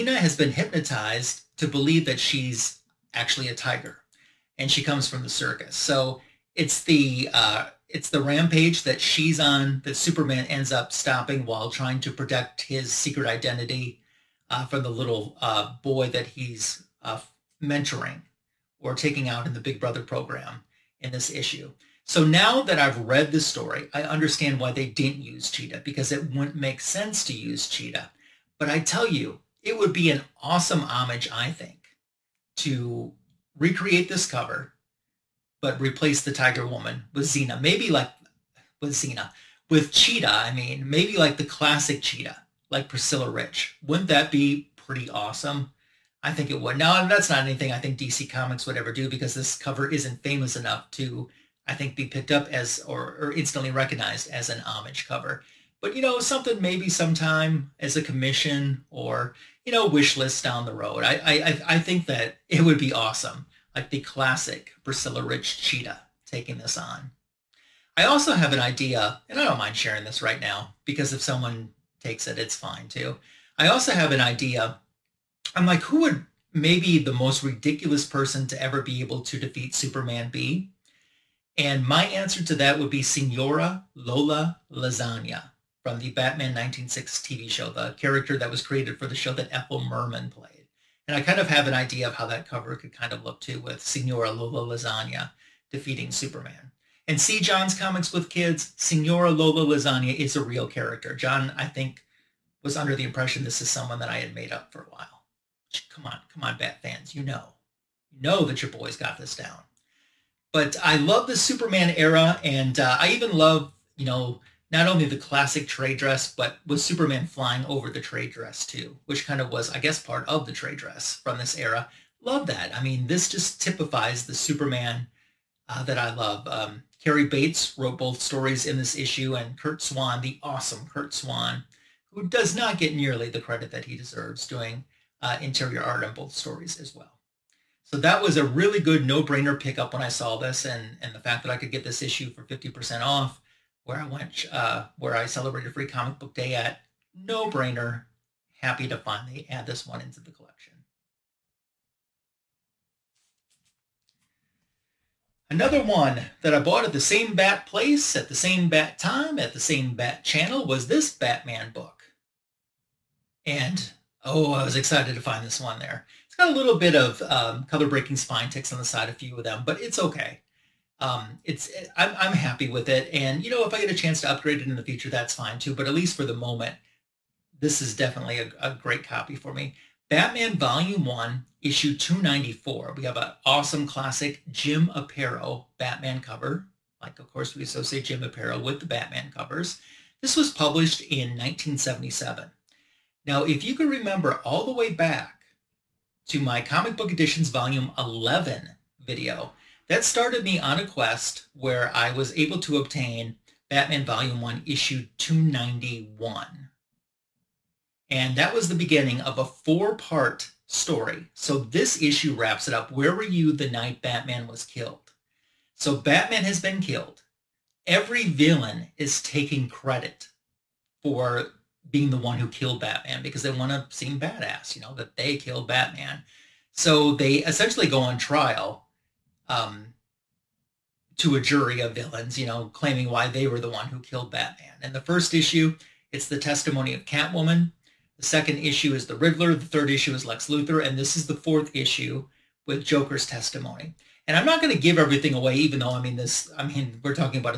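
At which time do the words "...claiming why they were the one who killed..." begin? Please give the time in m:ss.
3:52.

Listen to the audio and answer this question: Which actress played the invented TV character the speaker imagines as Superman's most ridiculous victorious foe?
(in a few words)
Ethel Merman.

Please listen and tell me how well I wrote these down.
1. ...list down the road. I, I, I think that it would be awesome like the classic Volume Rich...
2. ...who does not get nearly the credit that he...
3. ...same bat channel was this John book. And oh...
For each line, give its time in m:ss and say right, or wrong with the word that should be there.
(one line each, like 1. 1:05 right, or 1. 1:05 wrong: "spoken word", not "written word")
1. 1:00 wrong: "Priscilla", not "Volume"
2. 2:12 right
3. 2:39 wrong: "Batman", not "John".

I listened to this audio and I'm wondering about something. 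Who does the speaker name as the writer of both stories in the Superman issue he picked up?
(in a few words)
Cary Bates.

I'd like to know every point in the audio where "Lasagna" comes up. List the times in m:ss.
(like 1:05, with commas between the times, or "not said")
1:24, 1:34, 1:39.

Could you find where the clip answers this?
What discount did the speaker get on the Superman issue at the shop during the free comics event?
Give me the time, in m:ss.
2:22.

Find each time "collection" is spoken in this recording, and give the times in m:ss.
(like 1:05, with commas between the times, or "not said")
2:30.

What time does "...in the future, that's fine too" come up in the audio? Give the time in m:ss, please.
2:54.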